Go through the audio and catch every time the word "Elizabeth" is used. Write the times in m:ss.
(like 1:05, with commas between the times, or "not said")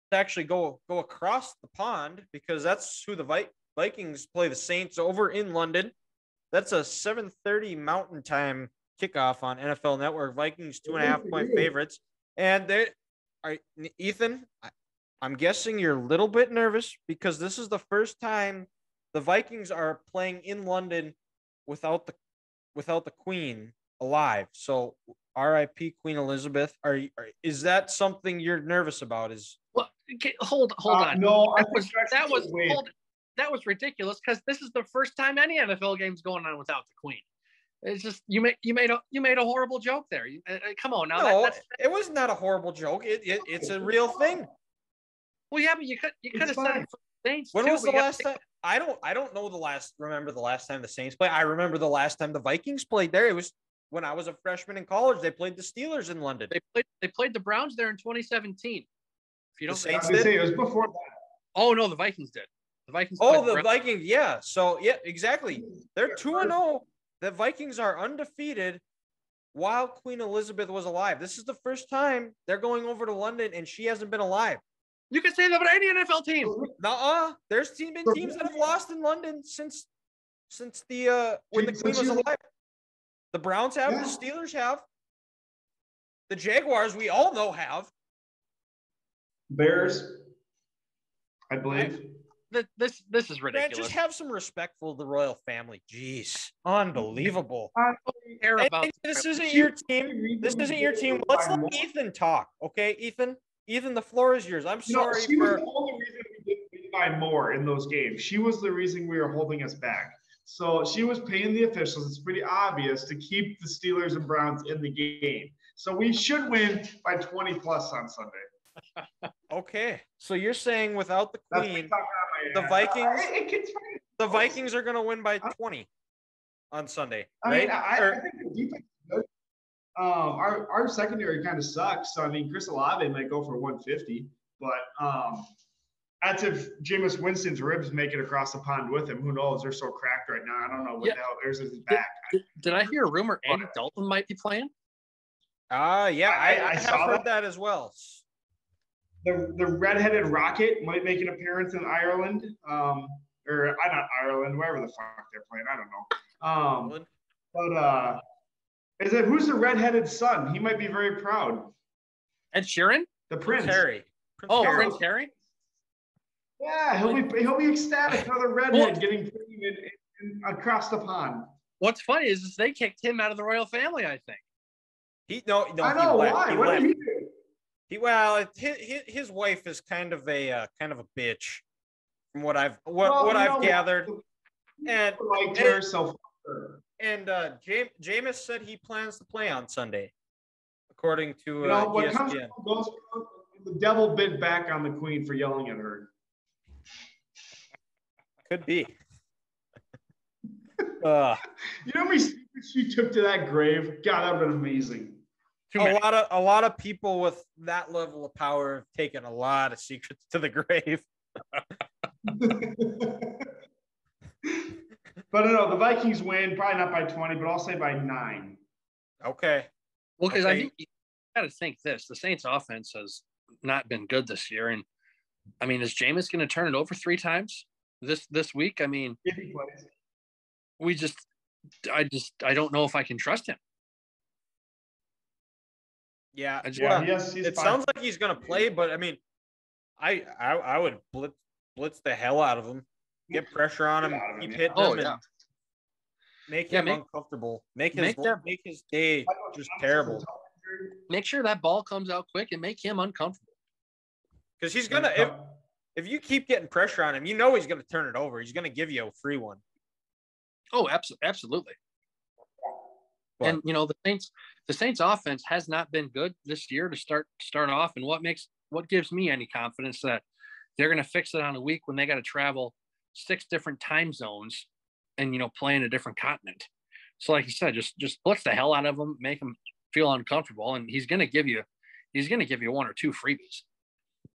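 0:26, 1:10.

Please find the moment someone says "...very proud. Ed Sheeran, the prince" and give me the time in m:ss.
2:40.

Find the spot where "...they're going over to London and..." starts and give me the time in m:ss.
1:12.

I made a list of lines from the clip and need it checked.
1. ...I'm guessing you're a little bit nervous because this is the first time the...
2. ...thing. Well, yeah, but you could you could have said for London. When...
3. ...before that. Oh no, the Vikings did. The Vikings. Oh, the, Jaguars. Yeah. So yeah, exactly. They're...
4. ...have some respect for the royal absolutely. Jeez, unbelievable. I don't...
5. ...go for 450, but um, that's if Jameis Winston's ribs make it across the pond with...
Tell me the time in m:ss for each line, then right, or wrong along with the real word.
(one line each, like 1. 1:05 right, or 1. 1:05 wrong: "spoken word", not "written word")
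1. 0:15 right
2. 0:44 wrong: "Saints", not "London"
3. 1:00 wrong: "Vikings", not "Jaguars"
4. 1:33 wrong: "family", not "absolutely"
5. 2:13 wrong: "150", not "450".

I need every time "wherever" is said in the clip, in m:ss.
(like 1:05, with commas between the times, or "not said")
2:34.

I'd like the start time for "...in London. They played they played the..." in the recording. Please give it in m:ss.
0:56.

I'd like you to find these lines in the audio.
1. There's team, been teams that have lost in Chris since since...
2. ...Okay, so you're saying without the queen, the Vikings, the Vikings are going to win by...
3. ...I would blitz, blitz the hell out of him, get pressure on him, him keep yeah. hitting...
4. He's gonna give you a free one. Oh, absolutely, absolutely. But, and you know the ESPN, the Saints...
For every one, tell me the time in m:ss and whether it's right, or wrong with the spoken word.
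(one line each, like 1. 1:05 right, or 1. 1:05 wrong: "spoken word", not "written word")
1. 1:17 wrong: "London", not "Chris"
2. 1:59 right
3. 4:00 right
4. 4:18 wrong: "Saints", not "ESPN".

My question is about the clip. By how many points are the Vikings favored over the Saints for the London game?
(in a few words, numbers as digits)
2.5.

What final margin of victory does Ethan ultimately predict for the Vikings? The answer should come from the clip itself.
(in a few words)
9.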